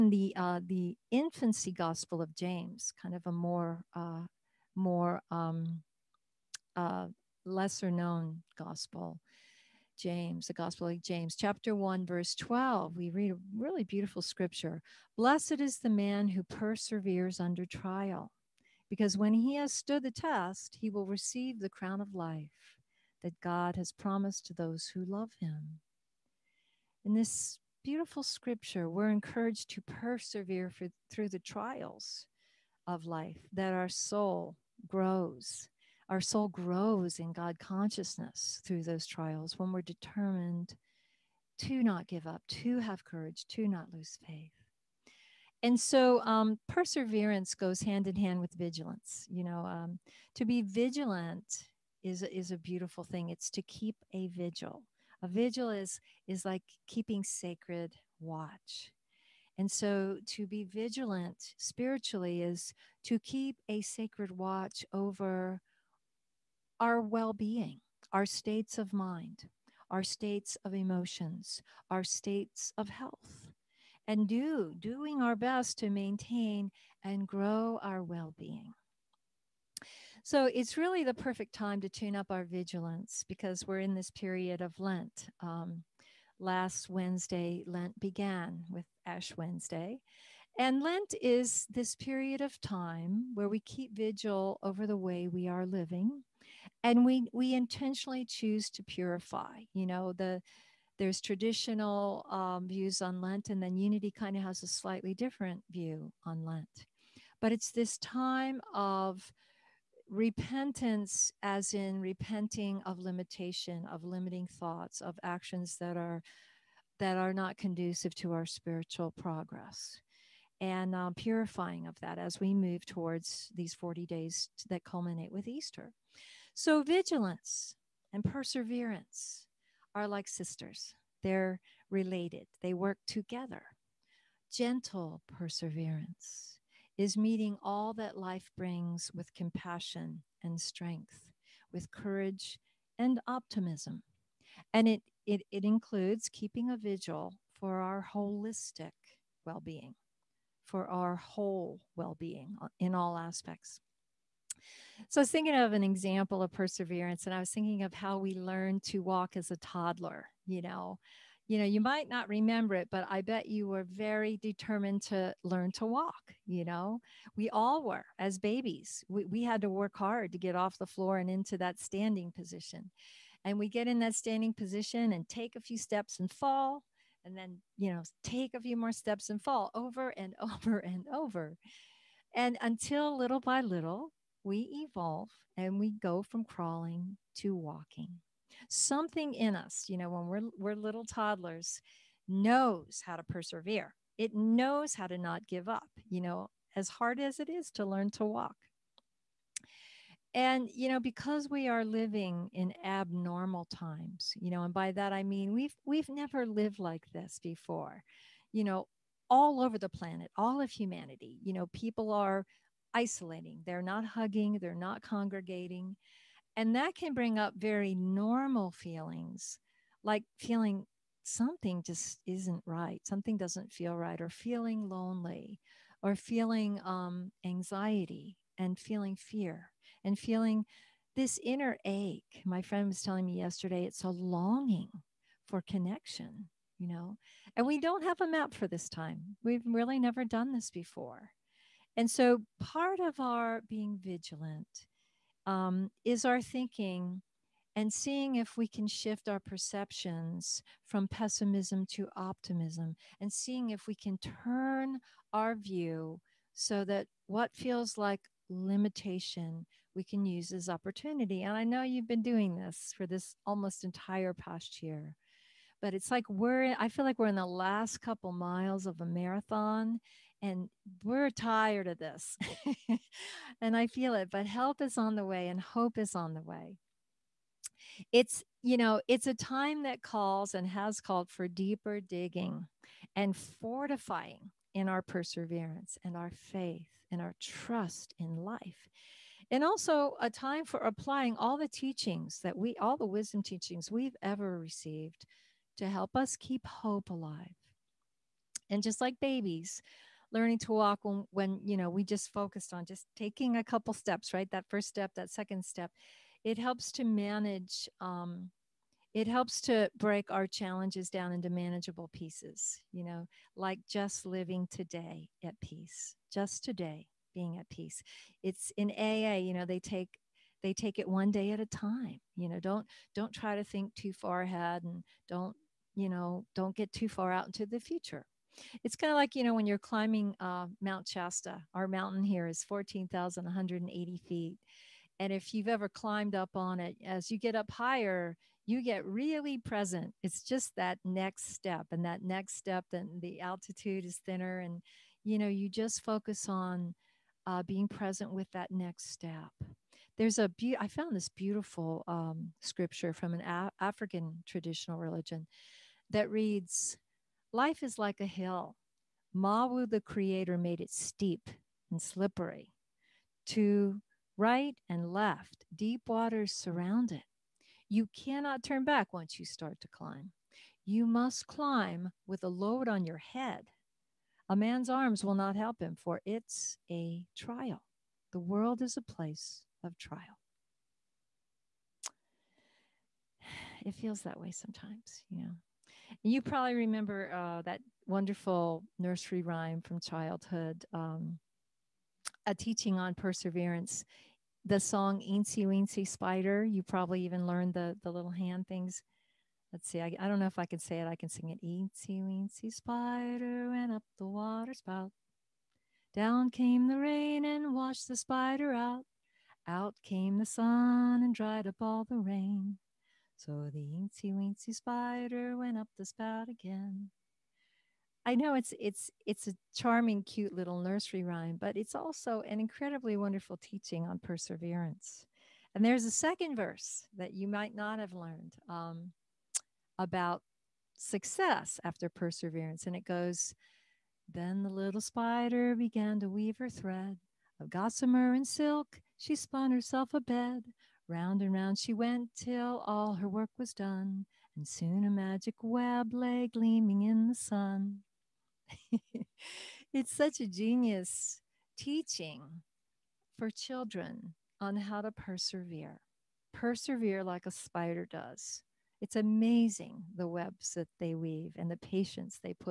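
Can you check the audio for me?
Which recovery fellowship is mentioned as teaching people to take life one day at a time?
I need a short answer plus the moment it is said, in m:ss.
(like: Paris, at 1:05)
AA, at 5:18.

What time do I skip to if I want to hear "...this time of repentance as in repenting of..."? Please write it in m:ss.
1:47.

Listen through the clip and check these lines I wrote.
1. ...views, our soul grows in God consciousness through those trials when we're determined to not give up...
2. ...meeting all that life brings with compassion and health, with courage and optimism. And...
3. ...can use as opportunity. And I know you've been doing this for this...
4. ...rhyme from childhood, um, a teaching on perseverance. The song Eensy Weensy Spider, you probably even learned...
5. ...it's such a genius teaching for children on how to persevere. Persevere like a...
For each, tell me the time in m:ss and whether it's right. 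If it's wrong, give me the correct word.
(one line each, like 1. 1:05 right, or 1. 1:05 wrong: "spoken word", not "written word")
1. 0:34 wrong: "grows", not "views"
2. 2:17 wrong: "strength", not "health"
3. 4:20 right
4. 6:29 right
5. 7:29 right.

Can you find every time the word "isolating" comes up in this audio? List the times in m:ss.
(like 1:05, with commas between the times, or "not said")
3:32.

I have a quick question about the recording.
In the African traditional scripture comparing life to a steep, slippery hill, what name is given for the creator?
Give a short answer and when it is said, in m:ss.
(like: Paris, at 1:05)
Mawu, at 5:59.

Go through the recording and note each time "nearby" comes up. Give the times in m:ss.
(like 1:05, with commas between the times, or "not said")
not said.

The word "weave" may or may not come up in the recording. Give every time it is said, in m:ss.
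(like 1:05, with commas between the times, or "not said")
7:16, 7:41.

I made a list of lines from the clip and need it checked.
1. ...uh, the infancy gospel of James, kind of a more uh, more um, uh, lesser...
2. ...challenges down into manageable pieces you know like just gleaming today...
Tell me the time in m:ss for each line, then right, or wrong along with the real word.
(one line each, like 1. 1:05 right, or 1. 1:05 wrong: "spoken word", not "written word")
1. 0:00 right
2. 5:10 wrong: "living", not "gleaming".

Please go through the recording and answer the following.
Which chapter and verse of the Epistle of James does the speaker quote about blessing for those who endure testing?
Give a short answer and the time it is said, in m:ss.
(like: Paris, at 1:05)
chapter 1, verse 12, at 0:11.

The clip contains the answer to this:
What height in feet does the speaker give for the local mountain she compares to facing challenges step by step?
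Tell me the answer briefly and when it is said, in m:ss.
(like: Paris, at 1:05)
14,180, at 5:32.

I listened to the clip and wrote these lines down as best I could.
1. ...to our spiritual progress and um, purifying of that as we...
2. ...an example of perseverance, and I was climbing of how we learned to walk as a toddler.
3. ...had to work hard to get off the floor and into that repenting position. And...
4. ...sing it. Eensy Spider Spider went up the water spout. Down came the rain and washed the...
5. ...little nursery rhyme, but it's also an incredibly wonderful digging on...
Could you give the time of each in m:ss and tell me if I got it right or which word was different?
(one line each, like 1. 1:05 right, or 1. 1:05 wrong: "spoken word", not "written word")
1. 1:58 right
2. 2:35 wrong: "thinking", not "climbing"
3. 2:49 wrong: "standing", not "repenting"
4. 6:41 wrong: "Weensy", not "Spider"
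5. 7:00 wrong: "teaching", not "digging".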